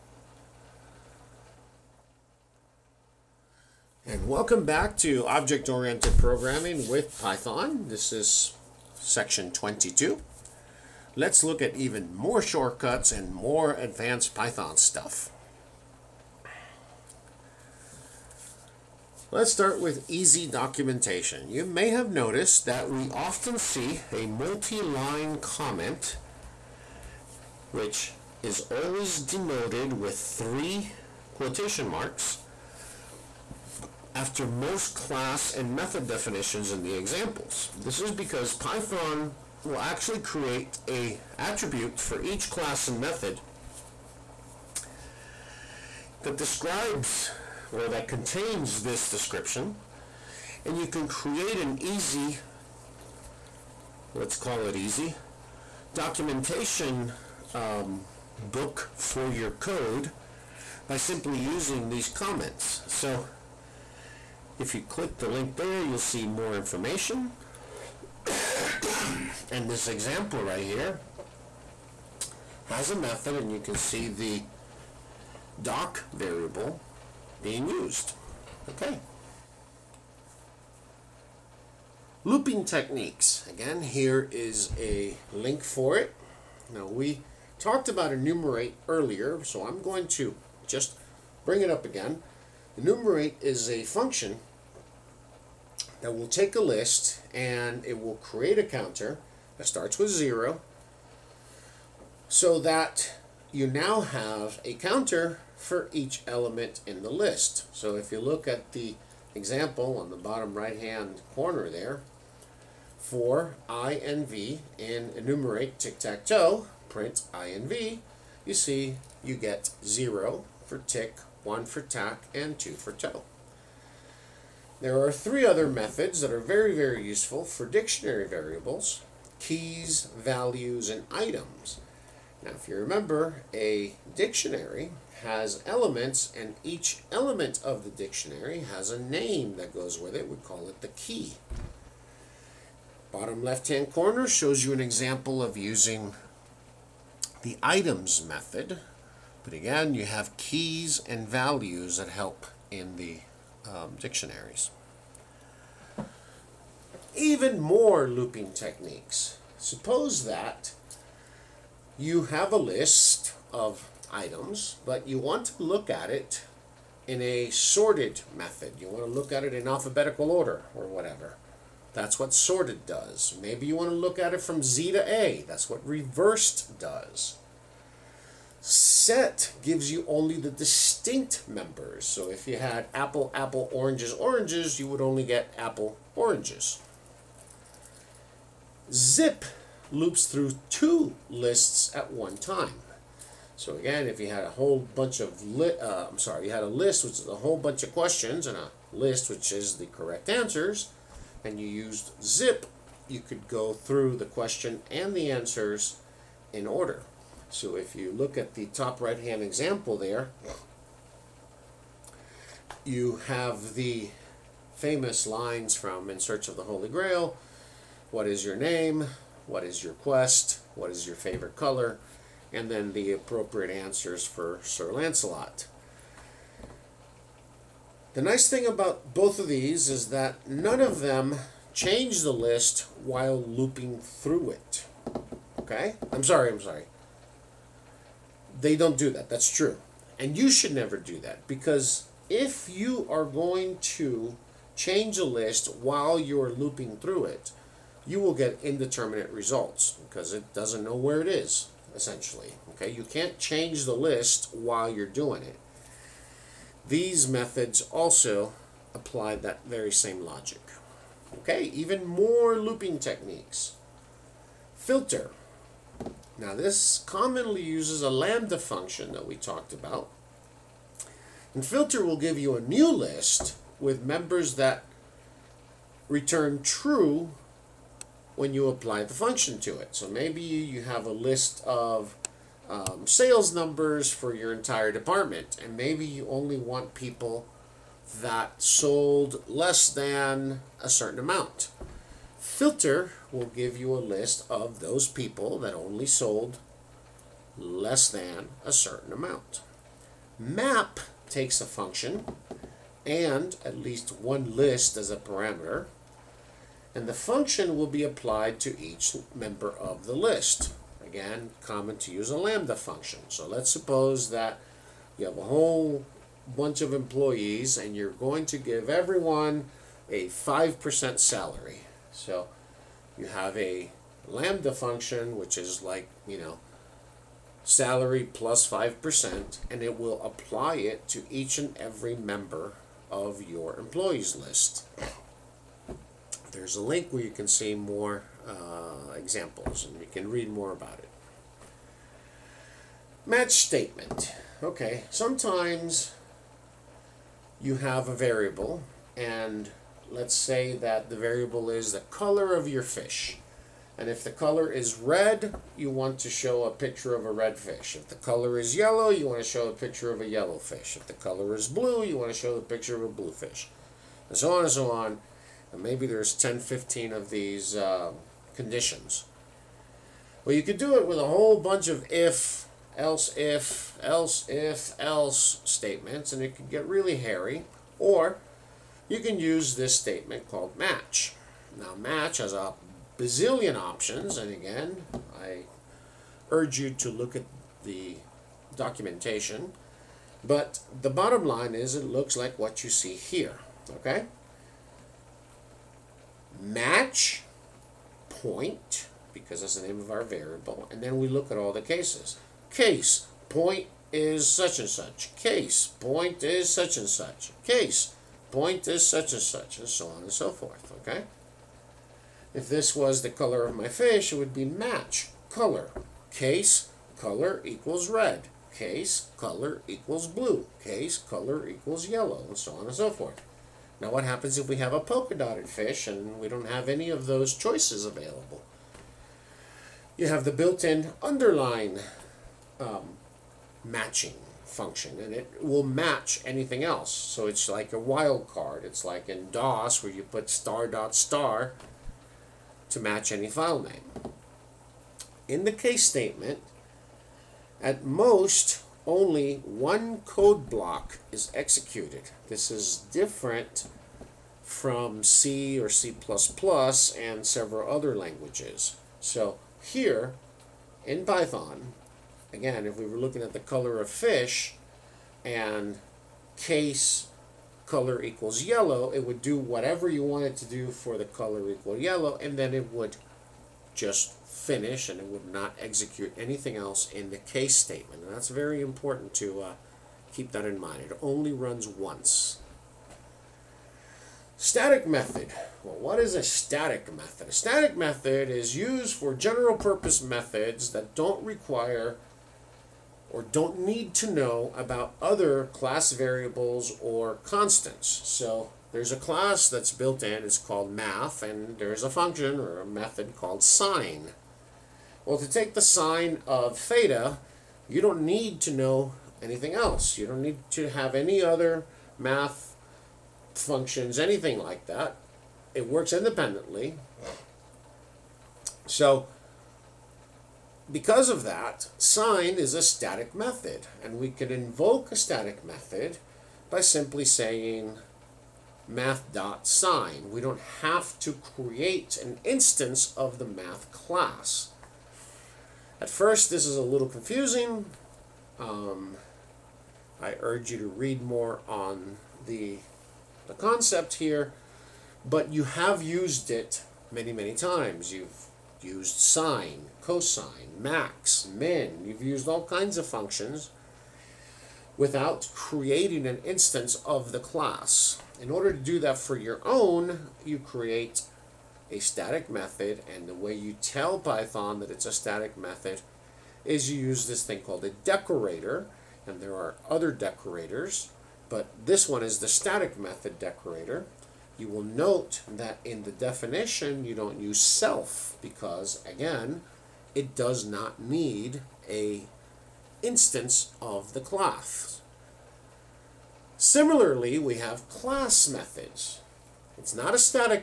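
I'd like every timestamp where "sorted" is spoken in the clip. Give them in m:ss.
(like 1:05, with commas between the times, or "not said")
2:47, 2:52.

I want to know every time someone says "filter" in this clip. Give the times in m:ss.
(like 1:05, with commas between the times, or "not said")
4:24, 4:31, 4:52.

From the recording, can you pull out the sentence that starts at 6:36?
match point, because that's the name of our variable, and then we look at all the cases.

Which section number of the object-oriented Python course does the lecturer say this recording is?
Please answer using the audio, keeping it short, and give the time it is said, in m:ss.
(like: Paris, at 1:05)
22, at 0:09.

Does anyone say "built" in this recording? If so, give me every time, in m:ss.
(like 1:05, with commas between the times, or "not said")
7:10, 8:19.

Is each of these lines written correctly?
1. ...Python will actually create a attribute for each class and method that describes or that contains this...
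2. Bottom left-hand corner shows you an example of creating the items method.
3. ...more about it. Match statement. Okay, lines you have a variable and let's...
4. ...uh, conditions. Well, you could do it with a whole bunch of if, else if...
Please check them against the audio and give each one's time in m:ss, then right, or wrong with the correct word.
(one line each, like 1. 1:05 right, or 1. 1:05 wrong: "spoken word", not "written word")
1. 0:38 right
2. 2:23 wrong: "using", not "creating"
3. 5:40 wrong: "sometimes", not "lines"
4. 6:07 right.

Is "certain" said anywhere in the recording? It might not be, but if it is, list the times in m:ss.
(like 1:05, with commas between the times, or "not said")
4:50, 4:58.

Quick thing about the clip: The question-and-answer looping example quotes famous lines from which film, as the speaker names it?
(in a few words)
In Search of the Holy Grail.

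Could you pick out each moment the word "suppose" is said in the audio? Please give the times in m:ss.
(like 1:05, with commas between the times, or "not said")
2:39, 5:13.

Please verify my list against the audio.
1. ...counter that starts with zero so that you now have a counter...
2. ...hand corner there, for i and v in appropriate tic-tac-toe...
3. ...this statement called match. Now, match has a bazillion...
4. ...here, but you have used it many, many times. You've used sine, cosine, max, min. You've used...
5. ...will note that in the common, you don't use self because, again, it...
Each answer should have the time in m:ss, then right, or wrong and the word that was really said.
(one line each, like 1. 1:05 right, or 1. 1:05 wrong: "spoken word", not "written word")
1. 1:38 right
2. 1:50 wrong: "enumerate", not "appropriate"
3. 6:19 right
4. 9:04 right
5. 9:34 wrong: "definition", not "common".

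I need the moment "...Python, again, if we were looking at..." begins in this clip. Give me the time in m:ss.
7:41.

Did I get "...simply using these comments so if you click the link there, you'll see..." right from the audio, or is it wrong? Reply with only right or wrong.
right.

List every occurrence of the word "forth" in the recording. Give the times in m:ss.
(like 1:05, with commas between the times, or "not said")
6:50, 7:03.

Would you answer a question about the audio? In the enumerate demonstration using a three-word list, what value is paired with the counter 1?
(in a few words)
tack.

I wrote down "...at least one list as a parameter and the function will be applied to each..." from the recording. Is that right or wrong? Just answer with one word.
right.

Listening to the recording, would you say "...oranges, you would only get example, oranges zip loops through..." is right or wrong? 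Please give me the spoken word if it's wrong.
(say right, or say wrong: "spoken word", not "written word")
wrong: "apple", not "example".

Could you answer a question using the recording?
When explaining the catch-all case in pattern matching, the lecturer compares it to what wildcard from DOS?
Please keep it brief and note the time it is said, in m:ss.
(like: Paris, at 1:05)
star dot star, at 7:20.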